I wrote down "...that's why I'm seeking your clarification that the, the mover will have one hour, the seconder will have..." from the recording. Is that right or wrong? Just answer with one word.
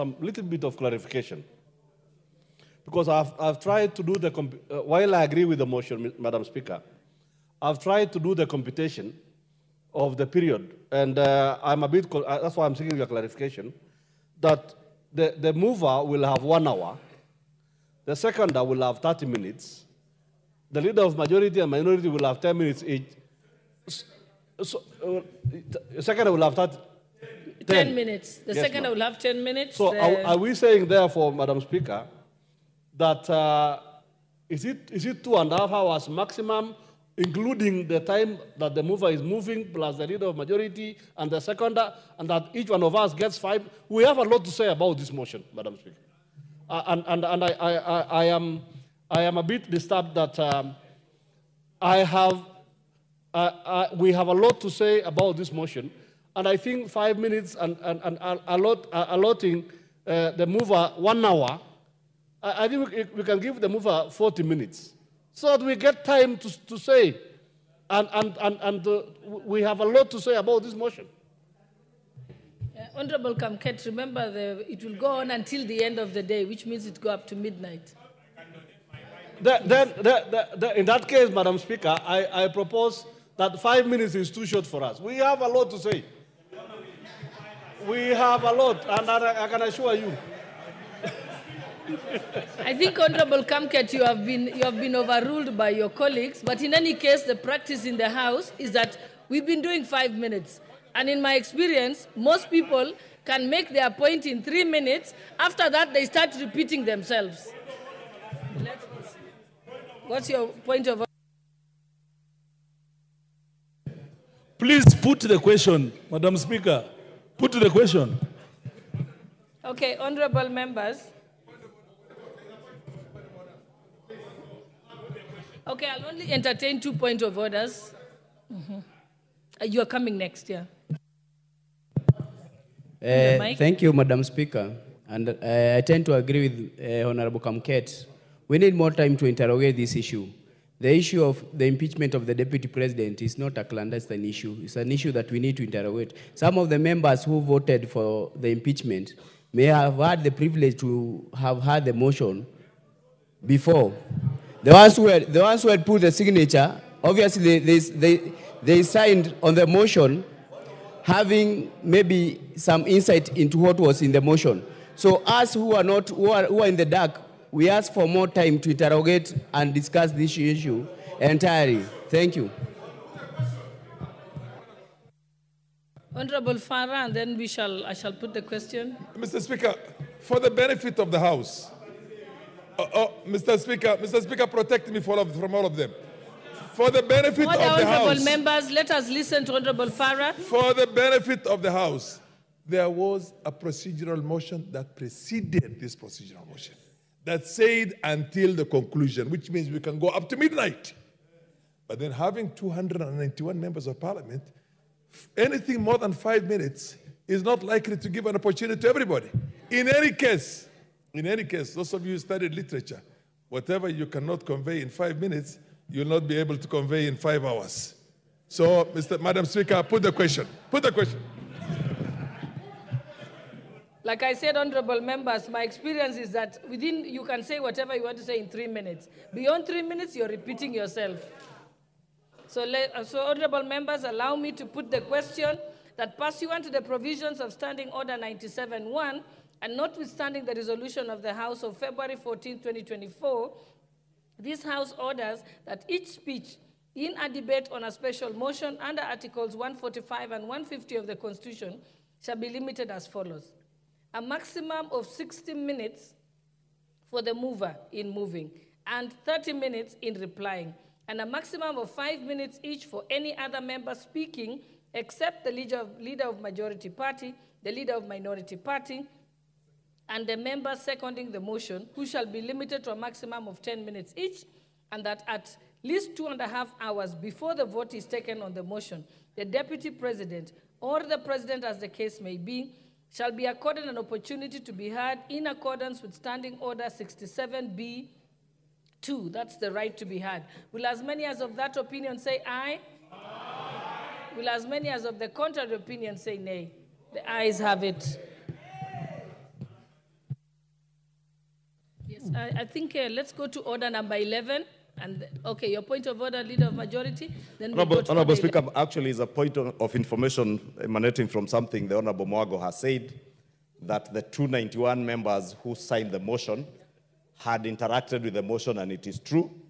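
right.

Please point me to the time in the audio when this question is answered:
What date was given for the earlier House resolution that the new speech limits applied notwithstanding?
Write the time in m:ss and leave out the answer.
4:01.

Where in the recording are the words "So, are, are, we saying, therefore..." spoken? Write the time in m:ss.
0:29.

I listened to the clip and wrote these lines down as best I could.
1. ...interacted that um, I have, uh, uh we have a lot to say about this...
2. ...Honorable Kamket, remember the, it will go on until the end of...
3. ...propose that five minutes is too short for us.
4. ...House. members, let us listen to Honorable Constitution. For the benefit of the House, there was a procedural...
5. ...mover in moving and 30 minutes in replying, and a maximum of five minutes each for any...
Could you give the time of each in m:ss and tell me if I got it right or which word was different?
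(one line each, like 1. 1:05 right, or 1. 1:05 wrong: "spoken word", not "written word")
1. 0:49 wrong: "disturbed", not "interacted"
2. 1:12 right
3. 1:22 right
4. 3:08 wrong: "Farah", not "Constitution"
5. 4:17 right.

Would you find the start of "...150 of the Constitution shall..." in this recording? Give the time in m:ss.
4:10.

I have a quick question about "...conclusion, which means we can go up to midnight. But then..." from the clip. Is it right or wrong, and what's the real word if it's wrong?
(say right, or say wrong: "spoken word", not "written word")
right.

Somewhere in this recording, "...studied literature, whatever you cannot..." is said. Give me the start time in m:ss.
3:32.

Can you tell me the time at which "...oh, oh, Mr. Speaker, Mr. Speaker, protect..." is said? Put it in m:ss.
3:02.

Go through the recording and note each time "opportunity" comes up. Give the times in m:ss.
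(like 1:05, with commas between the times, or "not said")
3:28, 4:43.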